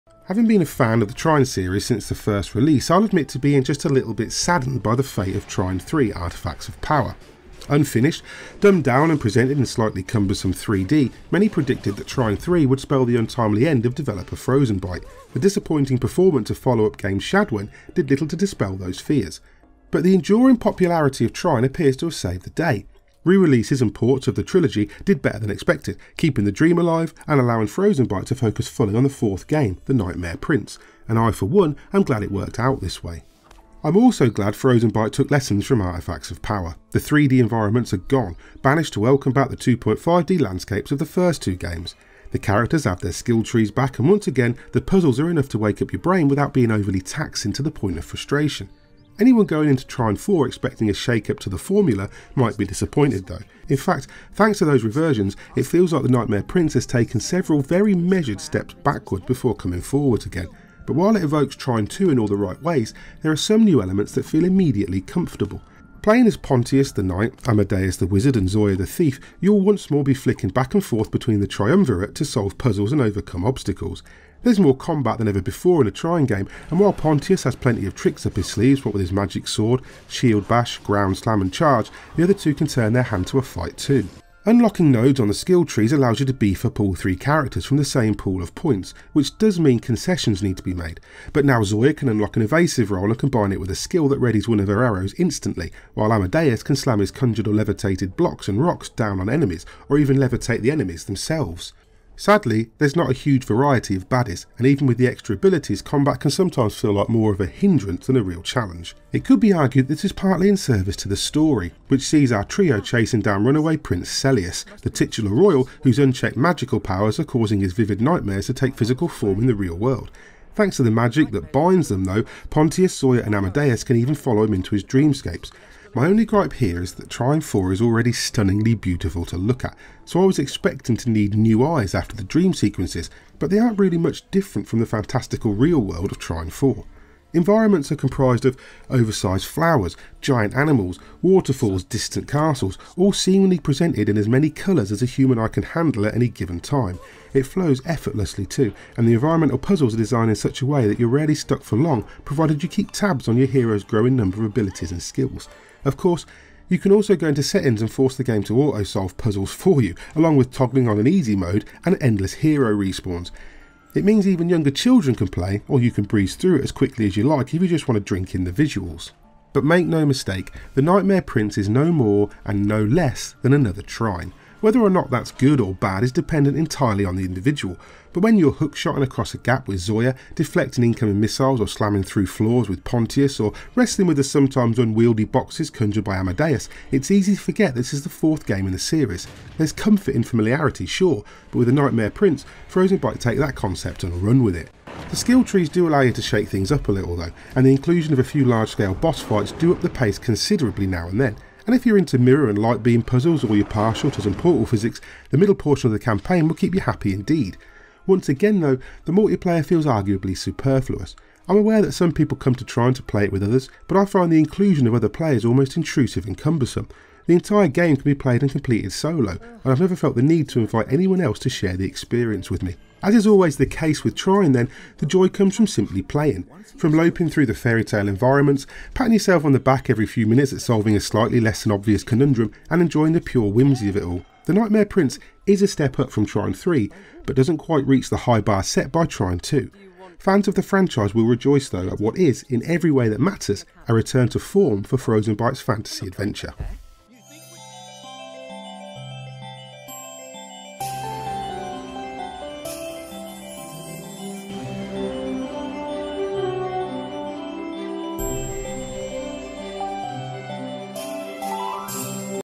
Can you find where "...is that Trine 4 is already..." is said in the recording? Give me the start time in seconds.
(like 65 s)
126 s.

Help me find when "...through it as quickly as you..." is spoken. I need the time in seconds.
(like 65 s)
166 s.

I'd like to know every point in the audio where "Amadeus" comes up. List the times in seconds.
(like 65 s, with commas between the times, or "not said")
67 s, 96 s, 123 s, 186 s.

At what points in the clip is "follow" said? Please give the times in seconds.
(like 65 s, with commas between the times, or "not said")
16 s, 124 s.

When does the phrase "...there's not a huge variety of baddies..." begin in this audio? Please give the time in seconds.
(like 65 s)
102 s.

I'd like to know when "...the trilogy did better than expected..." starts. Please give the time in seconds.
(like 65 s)
24 s.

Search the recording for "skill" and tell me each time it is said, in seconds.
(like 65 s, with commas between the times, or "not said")
43 s, 85 s, 93 s, 155 s, 195 s.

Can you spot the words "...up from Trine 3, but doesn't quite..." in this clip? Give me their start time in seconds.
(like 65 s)
235 s.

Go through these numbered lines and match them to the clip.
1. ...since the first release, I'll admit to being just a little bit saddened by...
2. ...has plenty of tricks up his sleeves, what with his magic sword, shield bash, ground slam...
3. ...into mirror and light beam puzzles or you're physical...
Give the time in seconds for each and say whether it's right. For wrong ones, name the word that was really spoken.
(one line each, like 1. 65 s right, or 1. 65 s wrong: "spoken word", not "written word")
1. 1 s right
2. 77 s right
3. 201 s wrong: "partial", not "physical".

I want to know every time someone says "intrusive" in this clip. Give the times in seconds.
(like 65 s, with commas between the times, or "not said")
215 s.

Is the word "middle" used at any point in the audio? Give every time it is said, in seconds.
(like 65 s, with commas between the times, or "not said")
205 s.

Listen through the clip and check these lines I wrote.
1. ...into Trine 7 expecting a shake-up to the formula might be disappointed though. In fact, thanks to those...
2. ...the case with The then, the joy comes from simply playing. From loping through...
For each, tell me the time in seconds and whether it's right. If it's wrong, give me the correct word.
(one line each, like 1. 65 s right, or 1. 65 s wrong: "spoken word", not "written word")
1. 49 s wrong: "4", not "7"
2. 223 s wrong: "Trine", not "The".